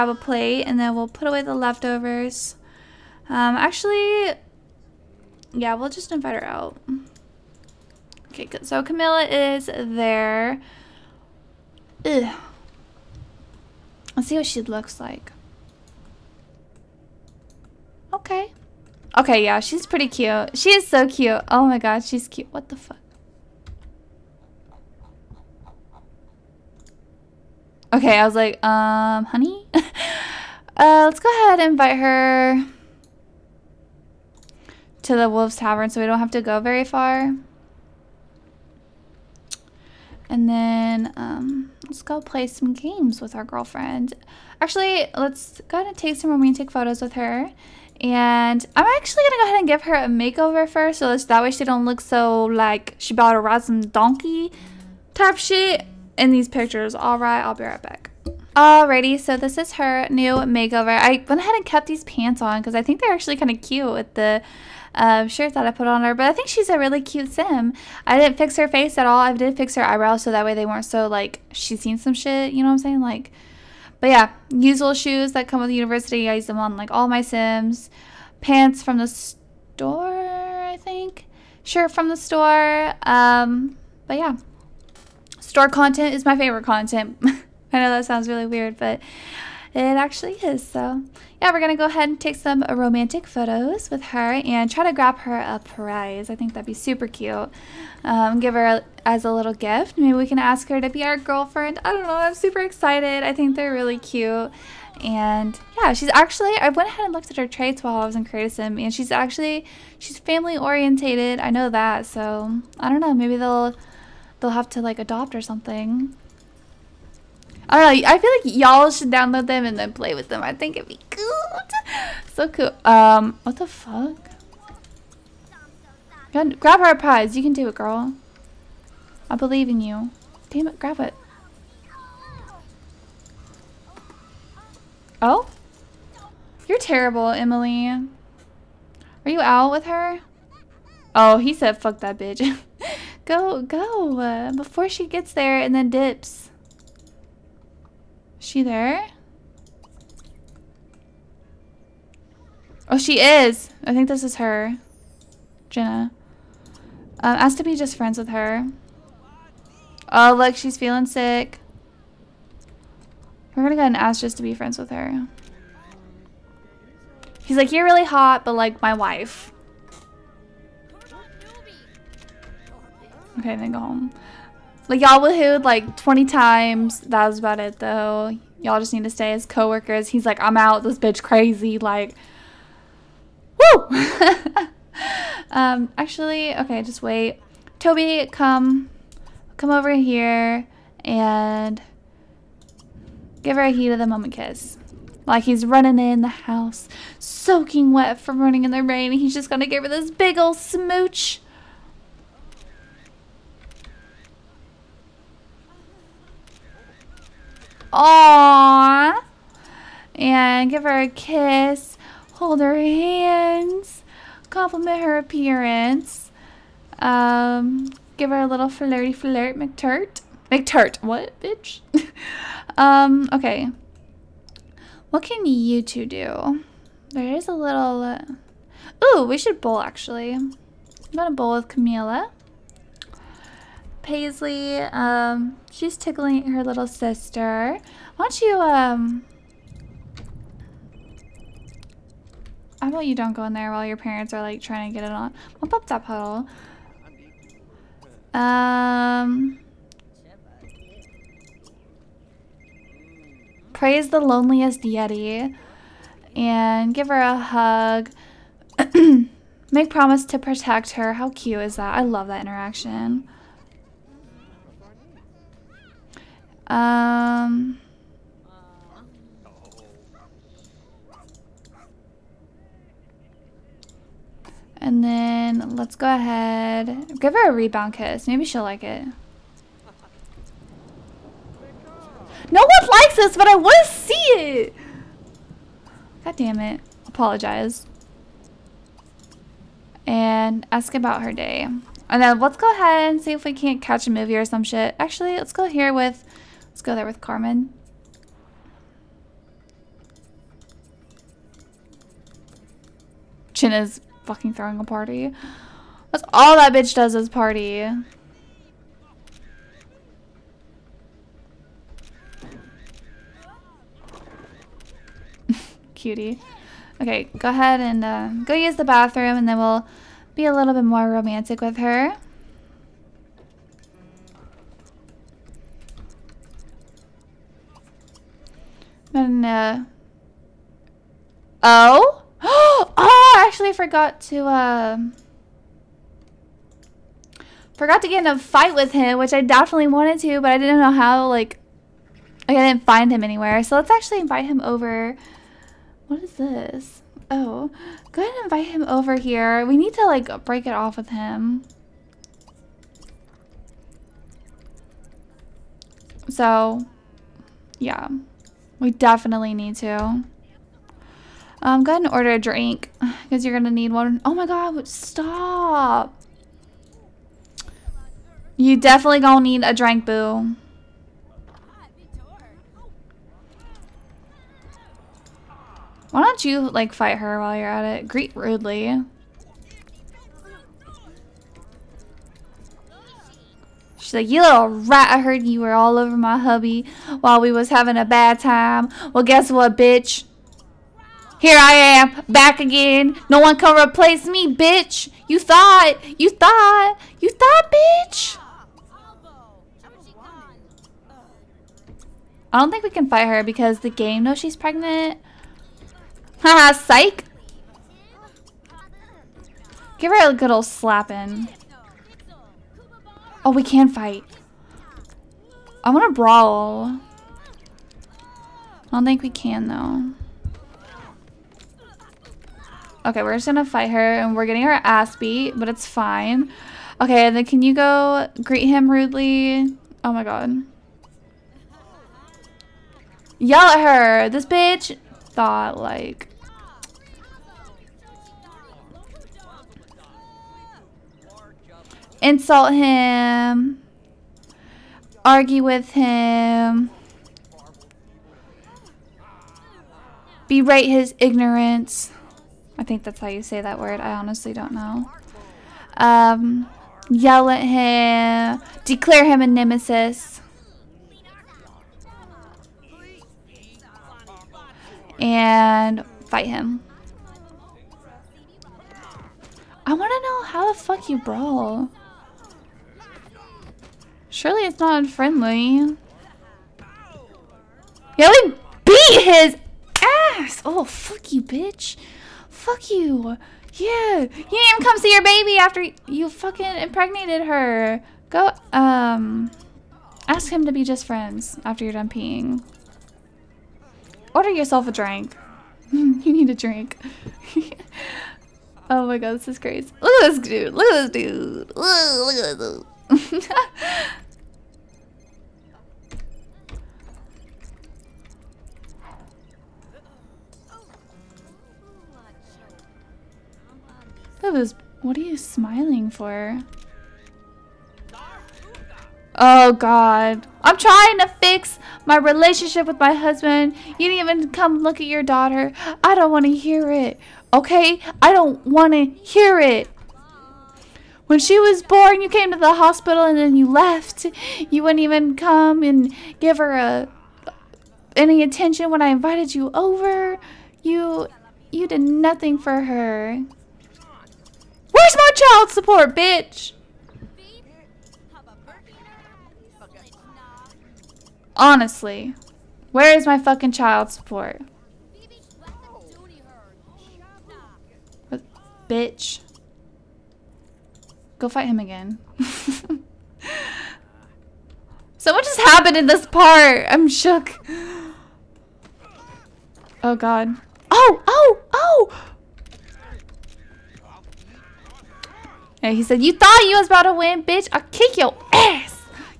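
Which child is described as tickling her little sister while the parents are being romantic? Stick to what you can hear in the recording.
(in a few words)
Paisley.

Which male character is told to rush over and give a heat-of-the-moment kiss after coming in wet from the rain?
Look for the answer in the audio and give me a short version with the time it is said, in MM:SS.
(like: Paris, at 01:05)
Toby, at 03:07.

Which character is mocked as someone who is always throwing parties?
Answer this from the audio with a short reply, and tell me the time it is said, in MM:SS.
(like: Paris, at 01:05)
Chinna, at 05:03.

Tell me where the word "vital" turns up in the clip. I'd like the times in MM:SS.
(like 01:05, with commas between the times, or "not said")
not said.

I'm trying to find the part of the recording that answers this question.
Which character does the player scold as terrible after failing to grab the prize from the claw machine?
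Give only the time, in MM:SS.
02:17.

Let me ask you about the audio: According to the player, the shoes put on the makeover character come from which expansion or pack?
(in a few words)
University.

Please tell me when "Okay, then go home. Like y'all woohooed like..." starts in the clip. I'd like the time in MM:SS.
02:53.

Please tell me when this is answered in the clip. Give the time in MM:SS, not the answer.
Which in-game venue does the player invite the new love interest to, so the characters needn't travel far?
00:35.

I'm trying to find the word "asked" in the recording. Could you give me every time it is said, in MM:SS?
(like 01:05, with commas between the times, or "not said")
02:37.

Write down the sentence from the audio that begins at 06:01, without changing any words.
Um, go ahead and order a drink because you're gonna need one.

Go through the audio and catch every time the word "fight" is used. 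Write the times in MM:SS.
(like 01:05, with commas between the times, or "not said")
05:38, 06:16, 06:43, 06:53, 07:03, 07:46, 09:21.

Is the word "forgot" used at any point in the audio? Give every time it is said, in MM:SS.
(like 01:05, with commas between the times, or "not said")
05:33, 05:37.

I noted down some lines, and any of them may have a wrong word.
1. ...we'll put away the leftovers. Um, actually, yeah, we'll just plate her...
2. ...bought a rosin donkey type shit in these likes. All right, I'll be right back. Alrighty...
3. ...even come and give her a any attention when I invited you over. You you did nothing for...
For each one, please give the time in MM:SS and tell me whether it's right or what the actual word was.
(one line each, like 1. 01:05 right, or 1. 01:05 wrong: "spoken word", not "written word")
1. 00:00 wrong: "invite", not "plate"
2. 00:53 wrong: "pictures", not "likes"
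3. 08:55 right.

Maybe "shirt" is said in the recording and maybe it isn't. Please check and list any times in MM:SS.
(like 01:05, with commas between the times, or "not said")
01:05, 01:21.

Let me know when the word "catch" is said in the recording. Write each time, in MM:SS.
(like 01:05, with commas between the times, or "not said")
04:53.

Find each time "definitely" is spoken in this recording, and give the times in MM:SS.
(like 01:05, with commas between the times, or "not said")
05:39, 05:58, 06:08.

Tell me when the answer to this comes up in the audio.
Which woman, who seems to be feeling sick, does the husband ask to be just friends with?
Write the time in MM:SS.
02:35.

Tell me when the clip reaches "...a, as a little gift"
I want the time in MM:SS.
01:38.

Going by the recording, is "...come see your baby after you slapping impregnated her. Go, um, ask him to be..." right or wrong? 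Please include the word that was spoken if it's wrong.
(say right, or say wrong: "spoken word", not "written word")
wrong: "fucking", not "slapping".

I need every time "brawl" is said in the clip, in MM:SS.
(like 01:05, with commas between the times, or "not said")
06:56, 07:51.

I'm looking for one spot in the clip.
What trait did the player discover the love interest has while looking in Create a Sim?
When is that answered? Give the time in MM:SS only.
01:50.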